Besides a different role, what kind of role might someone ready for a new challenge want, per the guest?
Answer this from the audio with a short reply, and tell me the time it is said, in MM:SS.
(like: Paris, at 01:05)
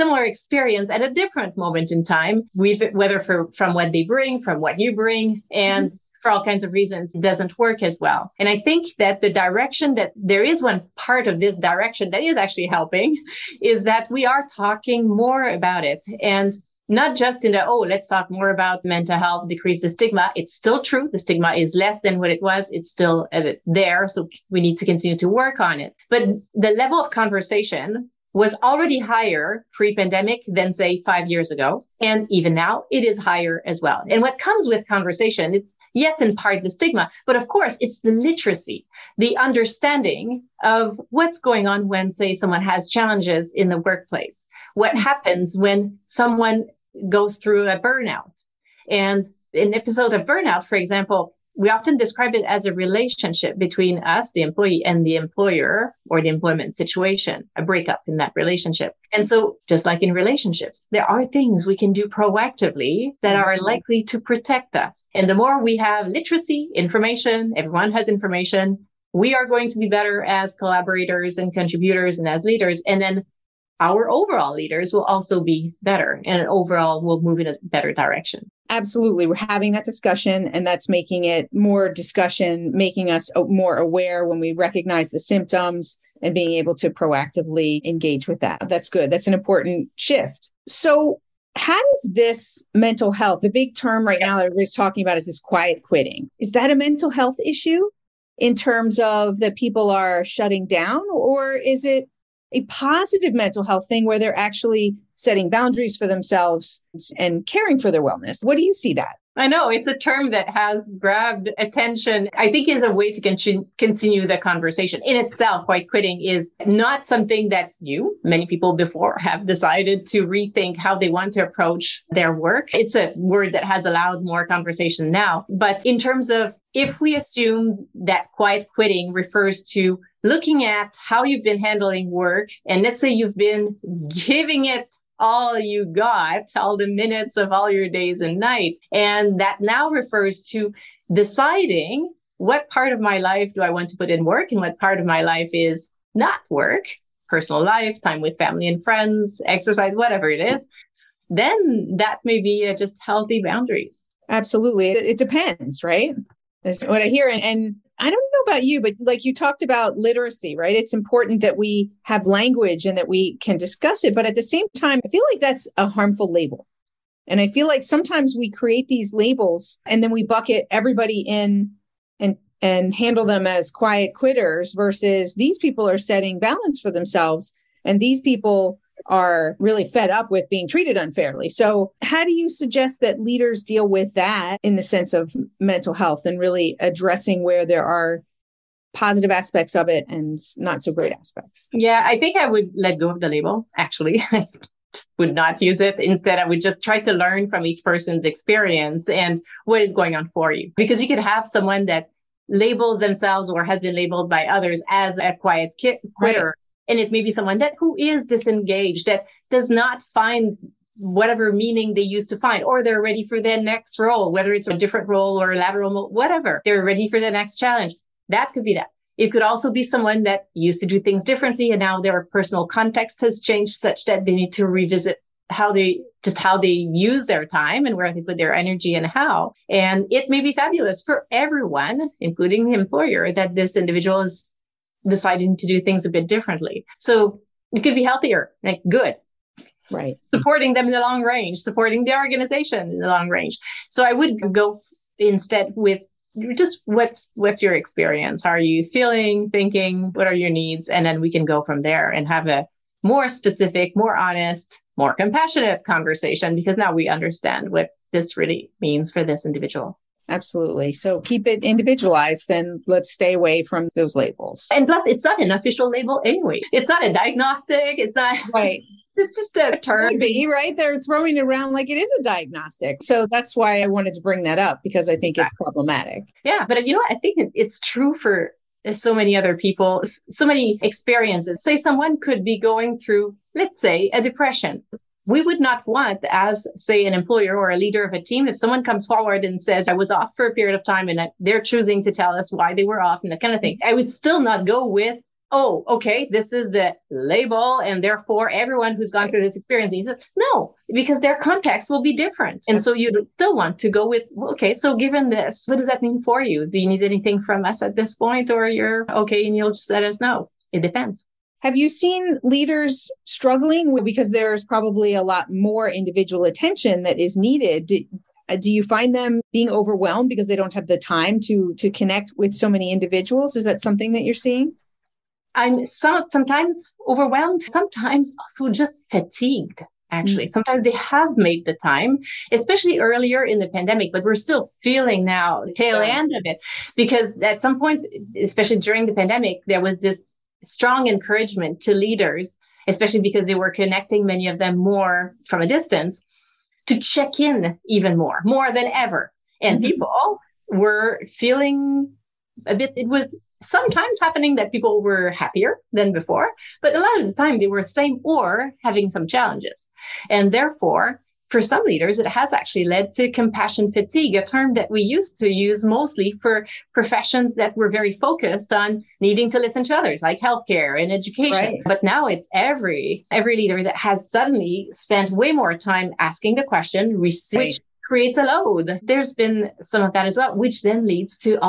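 lateral role, at 03:35.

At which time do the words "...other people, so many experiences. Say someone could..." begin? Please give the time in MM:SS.
04:39.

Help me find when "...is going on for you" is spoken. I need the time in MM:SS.
03:19.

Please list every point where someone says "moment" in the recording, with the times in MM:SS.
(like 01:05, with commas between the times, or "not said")
00:01.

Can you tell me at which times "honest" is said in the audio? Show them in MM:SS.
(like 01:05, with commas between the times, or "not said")
04:14.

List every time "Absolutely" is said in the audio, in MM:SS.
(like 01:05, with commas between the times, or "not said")
01:18, 02:34, 04:20.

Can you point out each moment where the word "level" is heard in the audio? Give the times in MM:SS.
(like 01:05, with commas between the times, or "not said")
00:26.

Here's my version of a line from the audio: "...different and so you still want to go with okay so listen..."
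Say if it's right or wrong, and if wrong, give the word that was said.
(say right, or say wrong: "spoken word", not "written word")
wrong: "given", not "listen".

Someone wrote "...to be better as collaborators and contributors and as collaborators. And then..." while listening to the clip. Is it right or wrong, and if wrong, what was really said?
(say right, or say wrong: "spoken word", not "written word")
wrong: "leaders", not "collaborators".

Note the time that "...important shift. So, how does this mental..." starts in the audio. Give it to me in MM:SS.
01:29.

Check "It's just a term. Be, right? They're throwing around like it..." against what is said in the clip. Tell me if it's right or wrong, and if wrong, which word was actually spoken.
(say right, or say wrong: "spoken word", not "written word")
right.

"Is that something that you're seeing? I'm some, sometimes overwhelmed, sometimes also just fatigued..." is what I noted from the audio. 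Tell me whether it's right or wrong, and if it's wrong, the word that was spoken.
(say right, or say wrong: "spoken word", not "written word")
right.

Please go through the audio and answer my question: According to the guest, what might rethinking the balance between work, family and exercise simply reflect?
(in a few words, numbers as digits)
healthy boundaries.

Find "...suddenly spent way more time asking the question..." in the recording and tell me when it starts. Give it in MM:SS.
06:14.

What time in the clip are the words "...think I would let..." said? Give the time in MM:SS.
03:12.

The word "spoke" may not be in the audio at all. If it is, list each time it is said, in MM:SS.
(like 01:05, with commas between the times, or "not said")
not said.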